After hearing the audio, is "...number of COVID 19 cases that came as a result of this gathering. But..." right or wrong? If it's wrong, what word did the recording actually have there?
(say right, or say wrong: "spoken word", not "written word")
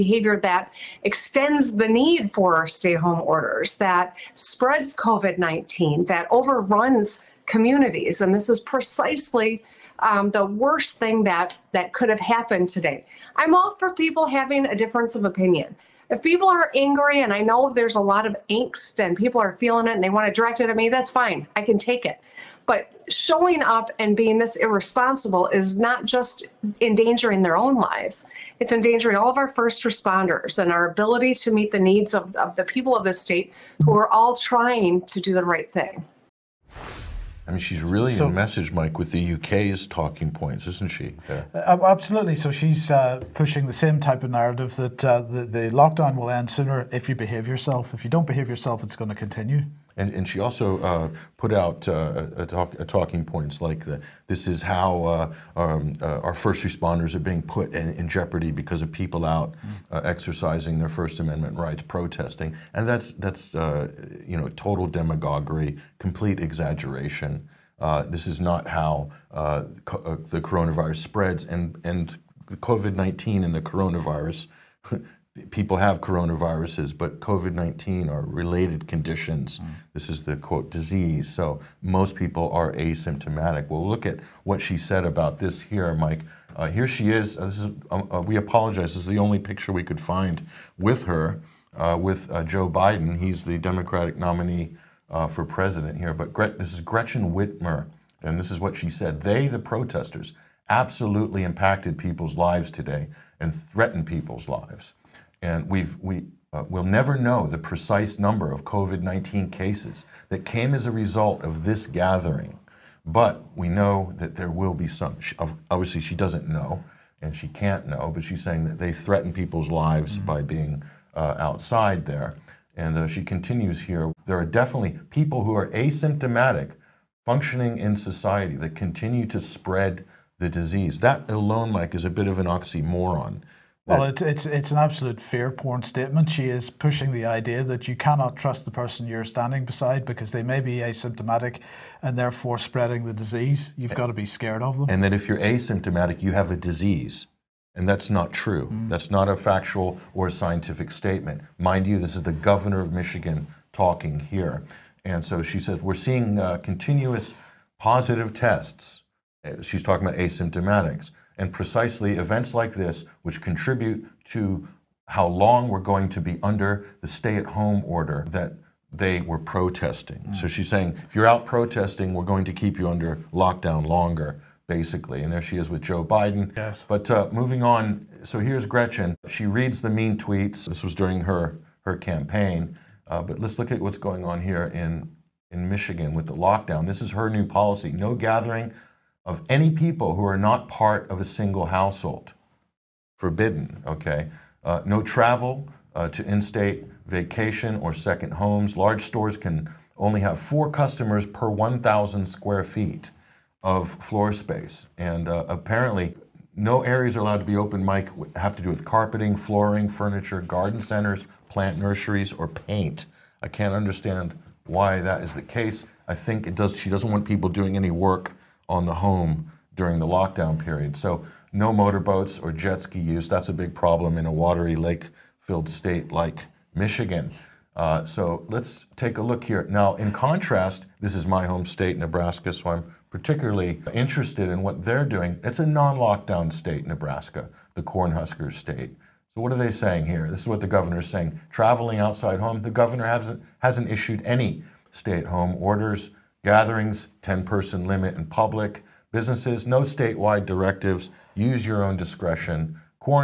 right.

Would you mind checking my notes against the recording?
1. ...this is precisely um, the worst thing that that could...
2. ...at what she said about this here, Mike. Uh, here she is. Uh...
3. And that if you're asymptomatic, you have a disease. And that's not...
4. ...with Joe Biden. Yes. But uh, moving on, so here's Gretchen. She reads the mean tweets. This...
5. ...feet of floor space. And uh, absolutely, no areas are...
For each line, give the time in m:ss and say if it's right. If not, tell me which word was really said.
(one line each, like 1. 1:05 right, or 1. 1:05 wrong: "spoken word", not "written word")
1. 0:08 right
2. 1:24 right
3. 2:24 right
4. 2:55 right
5. 3:22 wrong: "apparently", not "absolutely".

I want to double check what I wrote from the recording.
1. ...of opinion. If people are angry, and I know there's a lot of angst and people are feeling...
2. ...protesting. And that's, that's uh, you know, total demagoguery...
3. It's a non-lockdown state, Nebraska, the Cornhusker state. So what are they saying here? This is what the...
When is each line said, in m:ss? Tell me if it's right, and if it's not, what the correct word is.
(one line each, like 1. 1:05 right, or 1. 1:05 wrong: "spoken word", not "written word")
1. 0:15 right
2. 1:01 right
3. 3:55 right.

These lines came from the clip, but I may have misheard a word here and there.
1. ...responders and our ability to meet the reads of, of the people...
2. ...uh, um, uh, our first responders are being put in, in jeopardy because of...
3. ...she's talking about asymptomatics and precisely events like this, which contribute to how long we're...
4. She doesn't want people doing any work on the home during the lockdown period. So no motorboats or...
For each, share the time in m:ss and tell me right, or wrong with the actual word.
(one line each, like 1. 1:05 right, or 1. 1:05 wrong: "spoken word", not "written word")
1. 0:29 wrong: "needs", not "reads"
2. 0:55 right
3. 2:39 right
4. 3:36 right.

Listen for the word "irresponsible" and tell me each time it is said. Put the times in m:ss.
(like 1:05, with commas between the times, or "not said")
0:24.